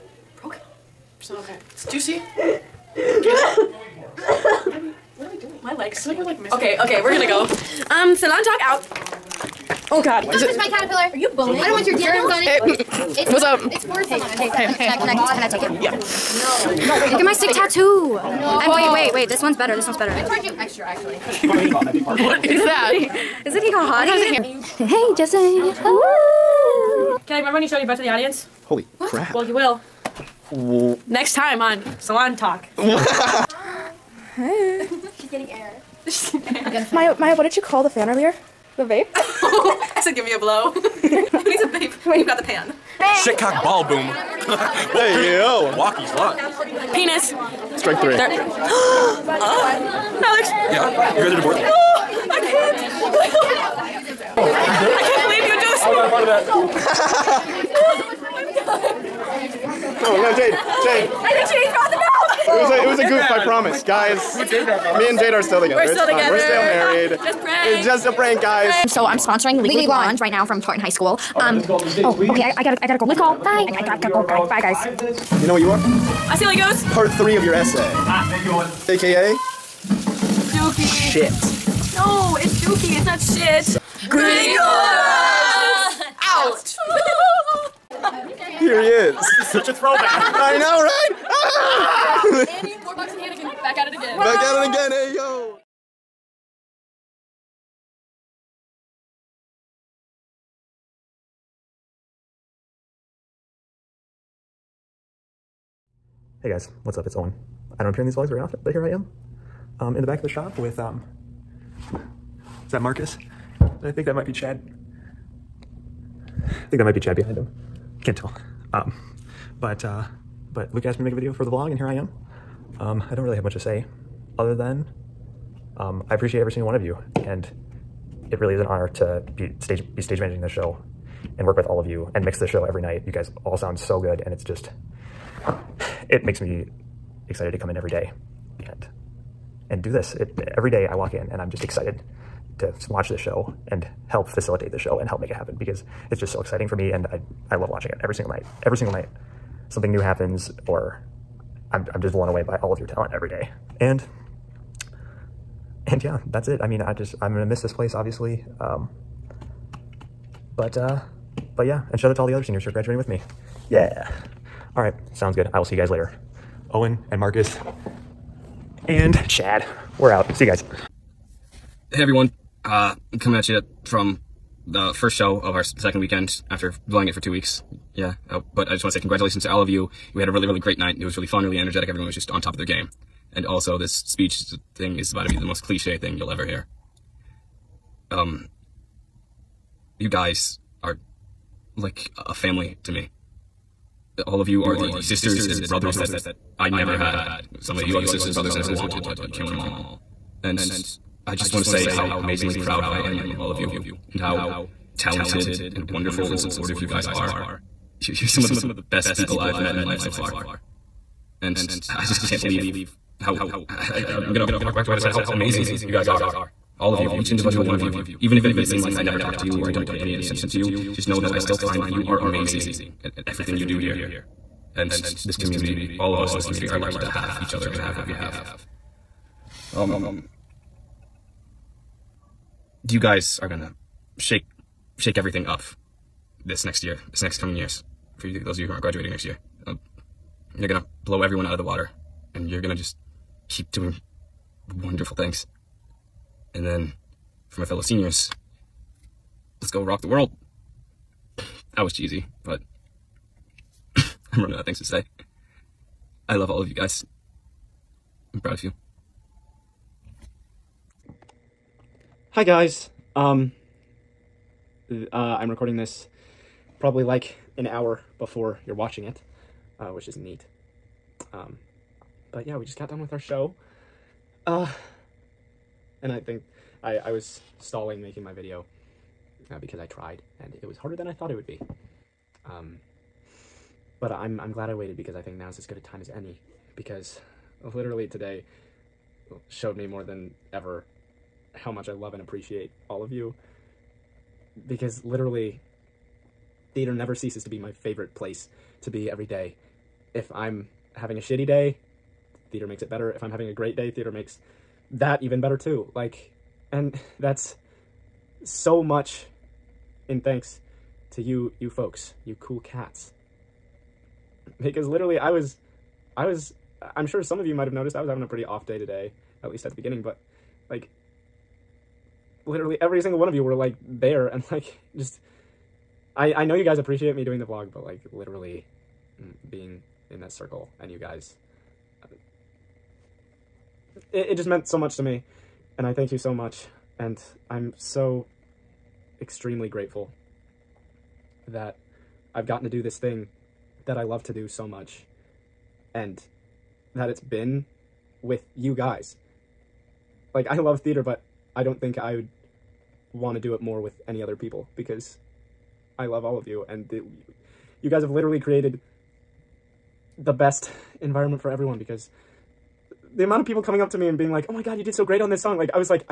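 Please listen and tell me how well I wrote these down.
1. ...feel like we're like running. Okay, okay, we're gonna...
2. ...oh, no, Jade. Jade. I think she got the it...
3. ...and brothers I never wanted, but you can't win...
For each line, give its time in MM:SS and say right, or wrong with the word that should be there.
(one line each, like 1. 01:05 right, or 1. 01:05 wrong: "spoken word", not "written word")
1. 00:06 wrong: "missing", not "running"
2. 01:00 right
3. 03:18 right.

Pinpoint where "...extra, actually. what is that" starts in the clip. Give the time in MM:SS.
00:20.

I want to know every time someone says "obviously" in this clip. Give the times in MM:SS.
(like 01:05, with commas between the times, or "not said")
02:37.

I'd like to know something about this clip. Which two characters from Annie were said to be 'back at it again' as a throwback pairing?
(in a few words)
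Warbucks and Hannigan.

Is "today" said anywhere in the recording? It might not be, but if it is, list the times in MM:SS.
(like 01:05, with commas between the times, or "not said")
04:48, 05:18.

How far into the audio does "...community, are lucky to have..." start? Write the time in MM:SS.
03:46.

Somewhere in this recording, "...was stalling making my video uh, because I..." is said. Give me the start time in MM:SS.
04:37.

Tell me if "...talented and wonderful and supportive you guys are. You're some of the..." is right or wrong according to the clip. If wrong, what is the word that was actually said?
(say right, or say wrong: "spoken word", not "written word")
right.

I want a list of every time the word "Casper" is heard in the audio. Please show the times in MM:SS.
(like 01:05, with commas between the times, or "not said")
not said.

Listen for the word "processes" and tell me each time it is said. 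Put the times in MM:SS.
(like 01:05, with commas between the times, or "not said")
not said.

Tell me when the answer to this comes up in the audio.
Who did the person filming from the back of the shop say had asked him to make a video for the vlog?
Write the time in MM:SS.
02:00.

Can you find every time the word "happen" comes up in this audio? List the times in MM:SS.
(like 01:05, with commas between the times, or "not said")
02:25, 02:30.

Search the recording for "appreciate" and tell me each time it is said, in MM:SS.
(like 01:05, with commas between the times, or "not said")
02:06, 04:52, 05:26.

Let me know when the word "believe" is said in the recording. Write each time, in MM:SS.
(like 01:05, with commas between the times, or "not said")
00:55, 03:32.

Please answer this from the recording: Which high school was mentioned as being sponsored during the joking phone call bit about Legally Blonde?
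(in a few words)
Tartan High School.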